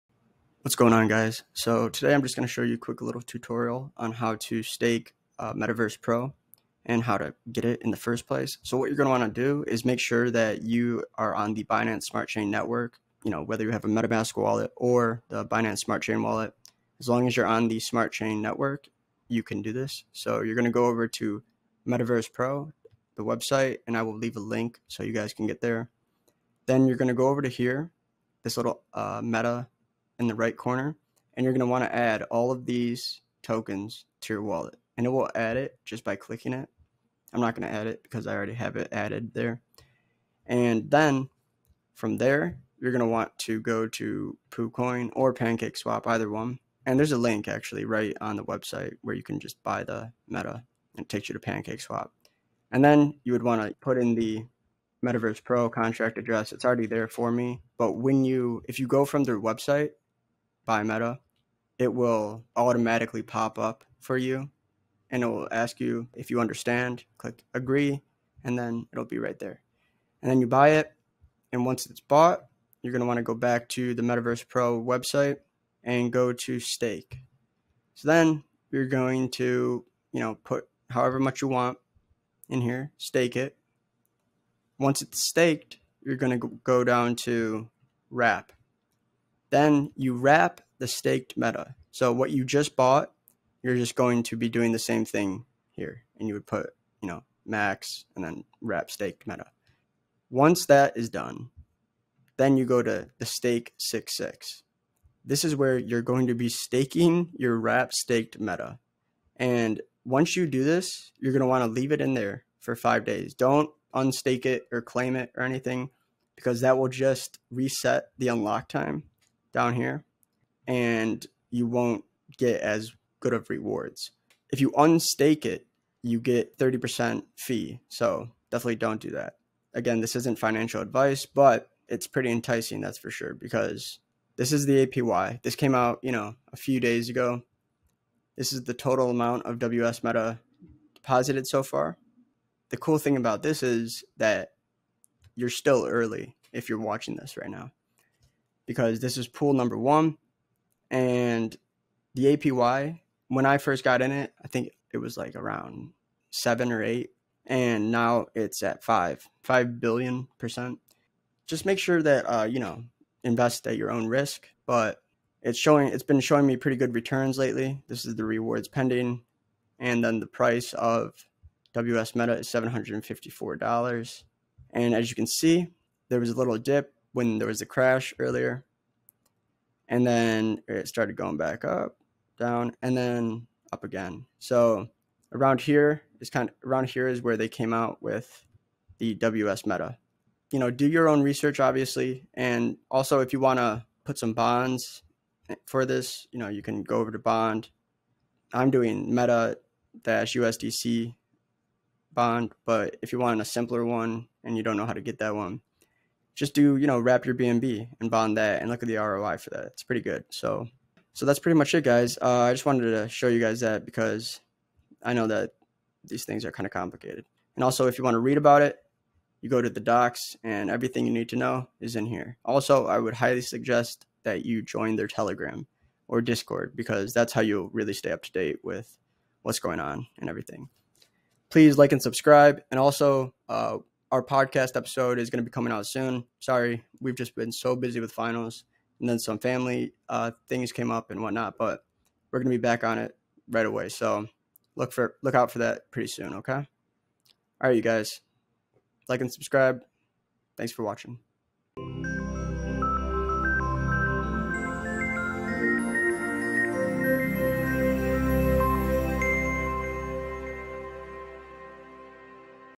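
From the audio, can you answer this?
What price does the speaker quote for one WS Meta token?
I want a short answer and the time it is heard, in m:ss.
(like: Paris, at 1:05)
$754, at 2:52.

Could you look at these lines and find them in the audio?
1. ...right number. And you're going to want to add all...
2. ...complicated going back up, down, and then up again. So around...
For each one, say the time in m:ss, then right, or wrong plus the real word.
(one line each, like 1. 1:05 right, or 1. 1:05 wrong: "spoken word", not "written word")
1. 0:30 wrong: "corner", not "number"
2. 3:00 wrong: "started", not "complicated".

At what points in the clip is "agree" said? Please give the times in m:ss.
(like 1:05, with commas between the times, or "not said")
1:07.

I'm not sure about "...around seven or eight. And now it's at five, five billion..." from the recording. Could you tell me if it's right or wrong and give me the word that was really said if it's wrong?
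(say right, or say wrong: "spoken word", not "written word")
right.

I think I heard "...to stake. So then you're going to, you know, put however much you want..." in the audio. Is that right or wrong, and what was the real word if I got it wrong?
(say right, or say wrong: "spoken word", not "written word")
right.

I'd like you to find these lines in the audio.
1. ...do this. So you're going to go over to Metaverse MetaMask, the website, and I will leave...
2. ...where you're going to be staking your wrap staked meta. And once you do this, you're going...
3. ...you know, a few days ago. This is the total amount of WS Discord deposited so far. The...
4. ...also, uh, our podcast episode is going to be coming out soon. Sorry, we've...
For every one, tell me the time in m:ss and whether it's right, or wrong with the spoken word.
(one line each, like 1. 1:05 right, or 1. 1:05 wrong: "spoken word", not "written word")
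1. 0:19 wrong: "Pro", not "MetaMask"
2. 1:45 right
3. 2:16 wrong: "Meta", not "Discord"
4. 3:52 right.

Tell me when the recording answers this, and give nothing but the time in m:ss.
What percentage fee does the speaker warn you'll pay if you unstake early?
2:06.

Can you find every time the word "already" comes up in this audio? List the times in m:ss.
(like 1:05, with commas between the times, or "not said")
0:38, 0:56.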